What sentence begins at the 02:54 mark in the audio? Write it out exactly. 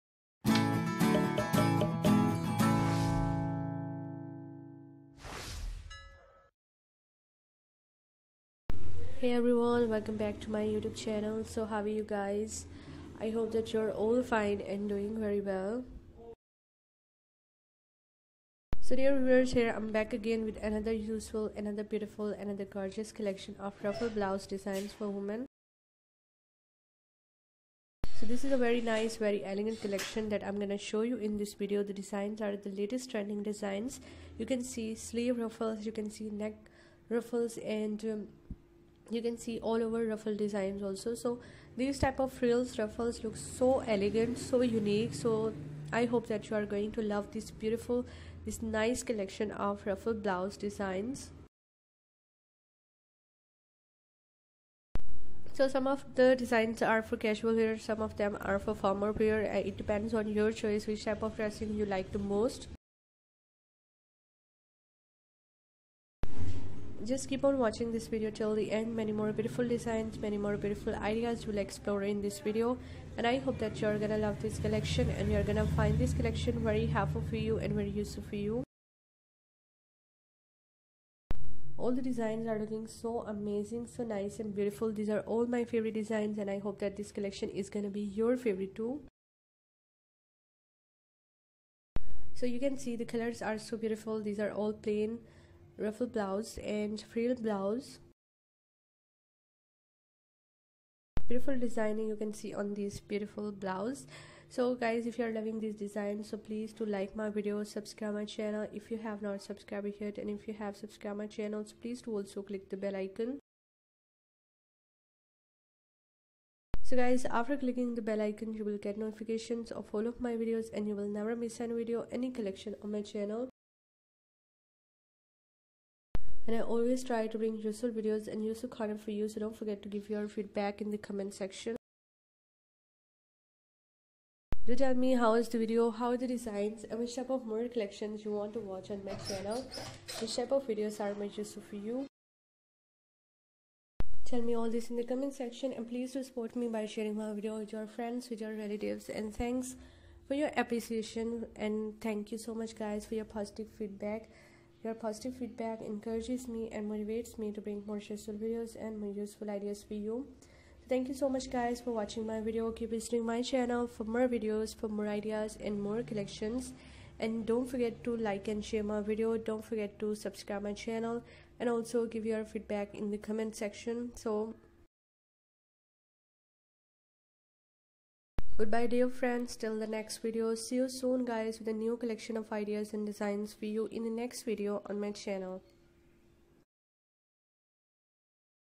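So Goodbye dear friends till the next video.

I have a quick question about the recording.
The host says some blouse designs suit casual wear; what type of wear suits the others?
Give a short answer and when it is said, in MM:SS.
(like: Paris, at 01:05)
formal wear, at 00:58.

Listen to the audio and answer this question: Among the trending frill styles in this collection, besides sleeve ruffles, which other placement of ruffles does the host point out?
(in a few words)
neck ruffles.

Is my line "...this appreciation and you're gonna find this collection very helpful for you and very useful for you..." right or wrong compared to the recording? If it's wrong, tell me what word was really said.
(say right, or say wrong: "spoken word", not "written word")
wrong: "collection", not "appreciation".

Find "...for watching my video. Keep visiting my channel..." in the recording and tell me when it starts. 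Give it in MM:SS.
02:41.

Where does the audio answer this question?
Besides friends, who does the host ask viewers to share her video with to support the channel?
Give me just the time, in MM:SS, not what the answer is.
02:28.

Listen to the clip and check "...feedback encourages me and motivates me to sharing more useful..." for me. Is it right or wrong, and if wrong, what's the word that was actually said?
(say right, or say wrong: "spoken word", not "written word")
wrong: "bring", not "sharing".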